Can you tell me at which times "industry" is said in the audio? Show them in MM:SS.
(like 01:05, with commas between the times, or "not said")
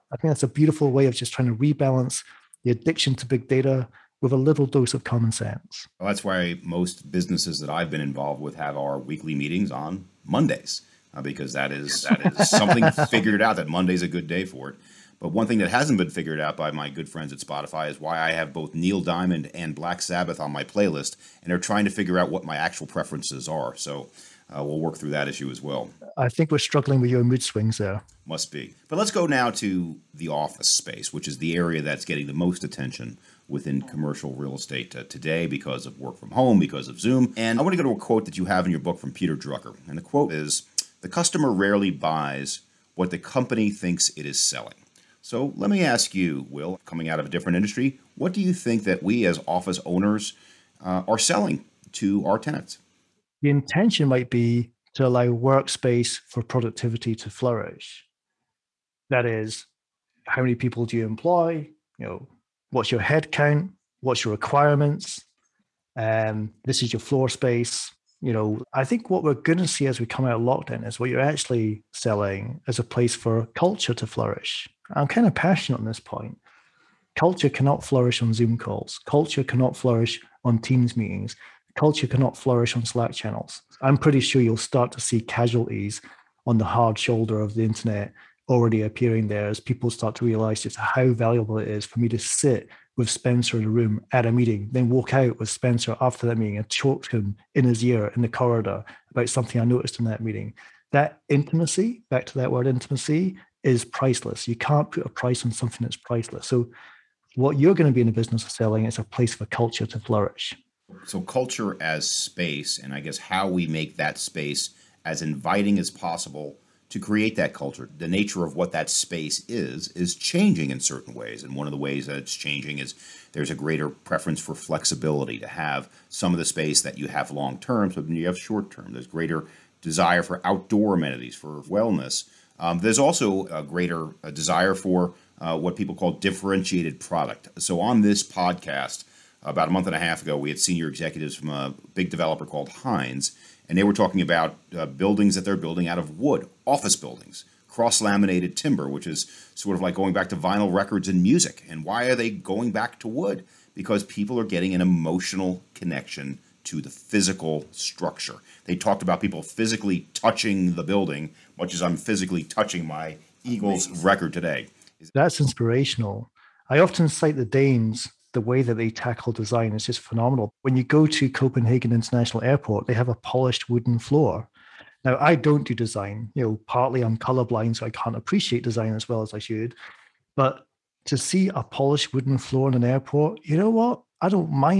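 00:47.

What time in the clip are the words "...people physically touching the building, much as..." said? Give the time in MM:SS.
02:39.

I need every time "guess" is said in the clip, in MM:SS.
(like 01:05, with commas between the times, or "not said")
01:52.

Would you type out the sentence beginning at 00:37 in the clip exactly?
And I want to go to a quote that you have in your book from Peter Drucker.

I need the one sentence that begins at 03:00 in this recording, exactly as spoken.
But to see a polished wooden floor in an airport, you know what?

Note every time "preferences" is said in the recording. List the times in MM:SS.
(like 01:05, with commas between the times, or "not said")
00:22, 02:03.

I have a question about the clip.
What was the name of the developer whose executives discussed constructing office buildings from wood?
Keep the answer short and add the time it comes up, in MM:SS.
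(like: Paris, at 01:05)
Heinz, at 02:22.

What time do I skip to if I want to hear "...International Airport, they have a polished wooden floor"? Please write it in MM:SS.
02:51.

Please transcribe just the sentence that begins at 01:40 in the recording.
That intimacy, back to that word intimacy, is priceless.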